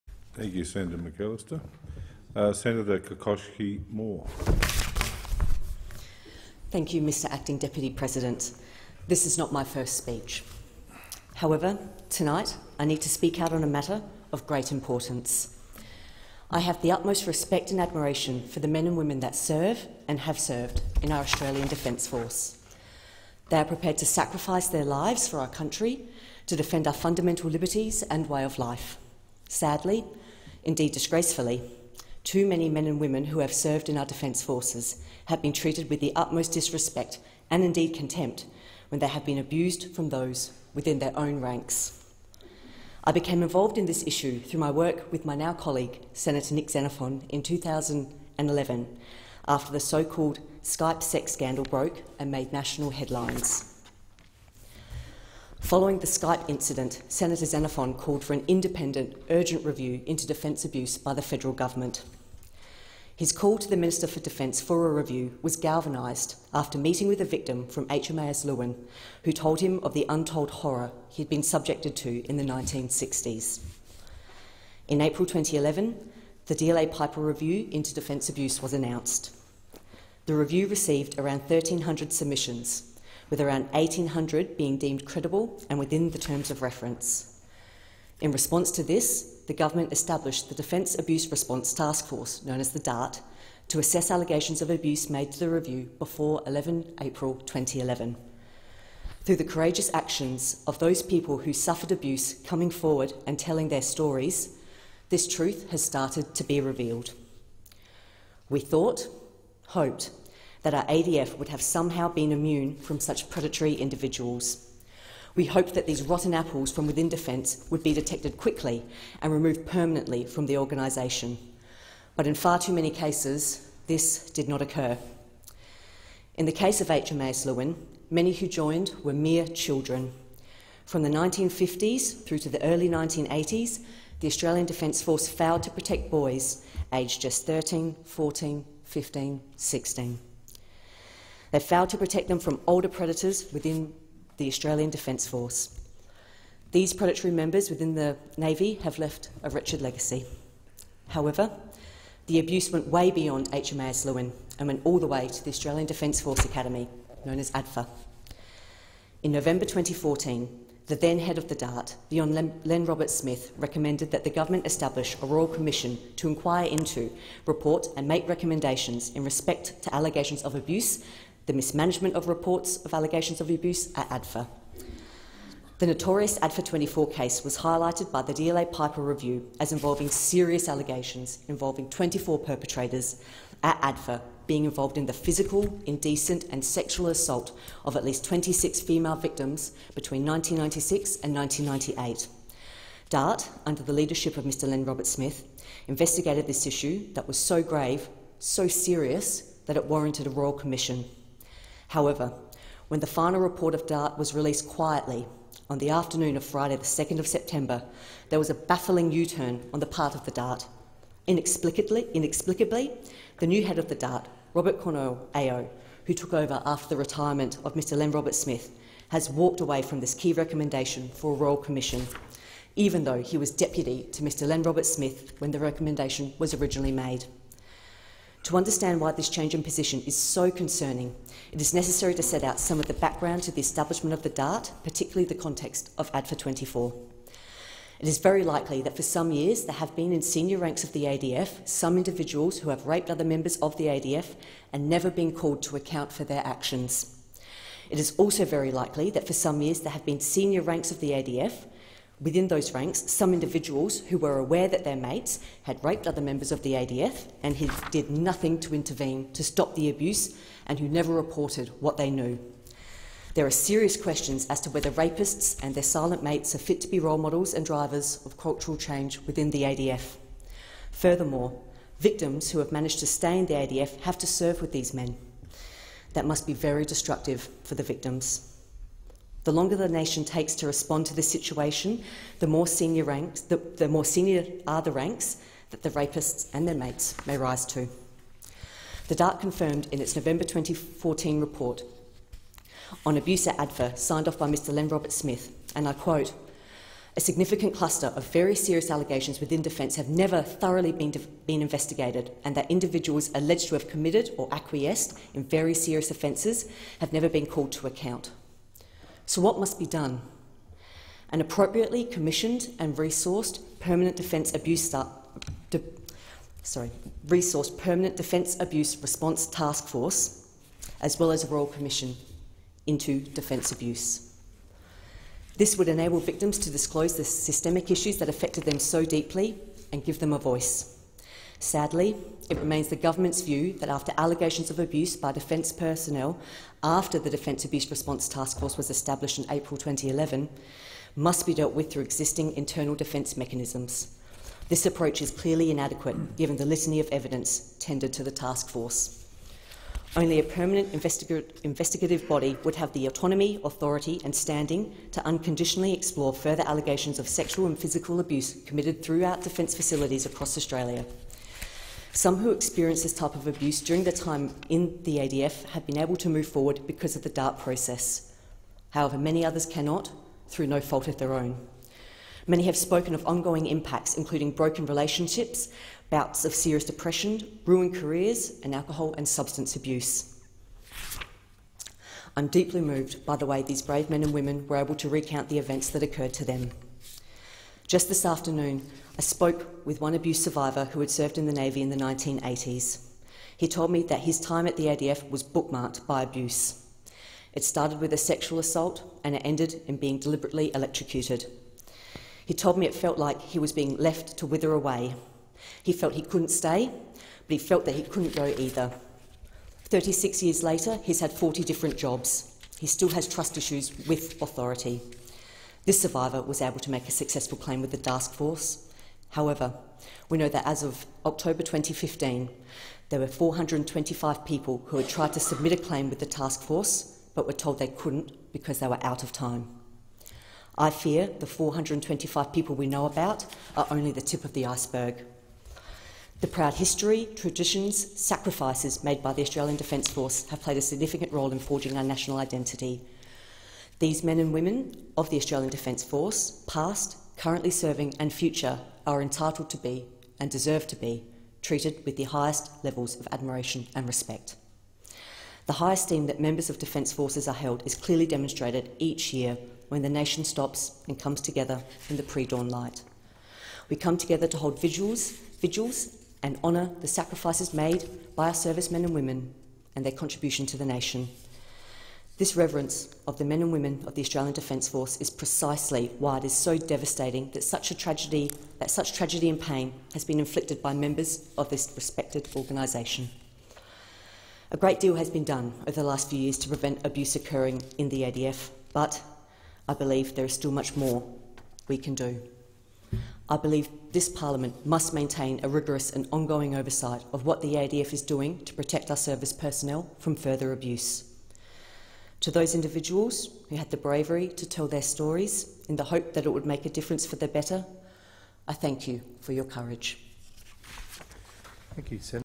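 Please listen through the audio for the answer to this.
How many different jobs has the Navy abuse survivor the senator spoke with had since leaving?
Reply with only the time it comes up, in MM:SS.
06:51.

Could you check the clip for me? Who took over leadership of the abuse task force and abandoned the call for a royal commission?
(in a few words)
Robert Cornall.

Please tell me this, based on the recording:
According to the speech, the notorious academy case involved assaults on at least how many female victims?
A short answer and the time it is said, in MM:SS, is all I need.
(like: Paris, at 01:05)
26, at 03:08.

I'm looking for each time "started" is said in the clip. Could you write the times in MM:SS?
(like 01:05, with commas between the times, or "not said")
01:45, 06:37.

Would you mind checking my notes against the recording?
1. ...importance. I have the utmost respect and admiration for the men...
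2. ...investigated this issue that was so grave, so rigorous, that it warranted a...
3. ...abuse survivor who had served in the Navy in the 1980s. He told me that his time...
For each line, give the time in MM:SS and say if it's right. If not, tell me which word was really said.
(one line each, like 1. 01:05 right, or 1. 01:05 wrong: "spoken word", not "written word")
1. 00:14 right
2. 03:15 wrong: "serious", not "rigorous"
3. 06:30 right.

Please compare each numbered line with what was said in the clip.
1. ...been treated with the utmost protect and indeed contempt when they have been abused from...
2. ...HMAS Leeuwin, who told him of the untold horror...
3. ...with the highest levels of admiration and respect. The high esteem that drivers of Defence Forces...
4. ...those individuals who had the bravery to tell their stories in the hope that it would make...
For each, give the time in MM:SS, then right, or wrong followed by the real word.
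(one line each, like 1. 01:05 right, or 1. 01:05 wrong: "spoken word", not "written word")
1. 00:35 wrong: "disrespect", not "protect"
2. 01:07 right
3. 07:32 wrong: "members", not "drivers"
4. 08:22 right.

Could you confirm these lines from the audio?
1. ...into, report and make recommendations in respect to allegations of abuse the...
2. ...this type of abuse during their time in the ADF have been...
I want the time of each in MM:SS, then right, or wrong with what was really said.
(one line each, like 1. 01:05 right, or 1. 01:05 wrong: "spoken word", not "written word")
1. 02:46 right
2. 06:03 right.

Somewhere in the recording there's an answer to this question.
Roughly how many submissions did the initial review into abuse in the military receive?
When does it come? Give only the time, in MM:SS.
01:21.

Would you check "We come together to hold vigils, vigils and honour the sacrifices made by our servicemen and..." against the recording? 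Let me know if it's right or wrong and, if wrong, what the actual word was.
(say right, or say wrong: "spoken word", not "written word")
right.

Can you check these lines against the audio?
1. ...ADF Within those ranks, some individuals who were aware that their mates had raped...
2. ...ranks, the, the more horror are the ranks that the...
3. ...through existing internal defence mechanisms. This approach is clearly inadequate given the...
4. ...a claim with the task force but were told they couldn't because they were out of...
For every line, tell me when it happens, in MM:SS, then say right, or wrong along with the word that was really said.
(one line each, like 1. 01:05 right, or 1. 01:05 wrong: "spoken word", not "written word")
1. 04:11 right
2. 04:43 wrong: "senior", not "horror"
3. 05:41 right
4. 07:05 right.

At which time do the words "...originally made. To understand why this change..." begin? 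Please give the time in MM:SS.
03:46.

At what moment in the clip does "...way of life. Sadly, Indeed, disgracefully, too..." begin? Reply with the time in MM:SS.
00:28.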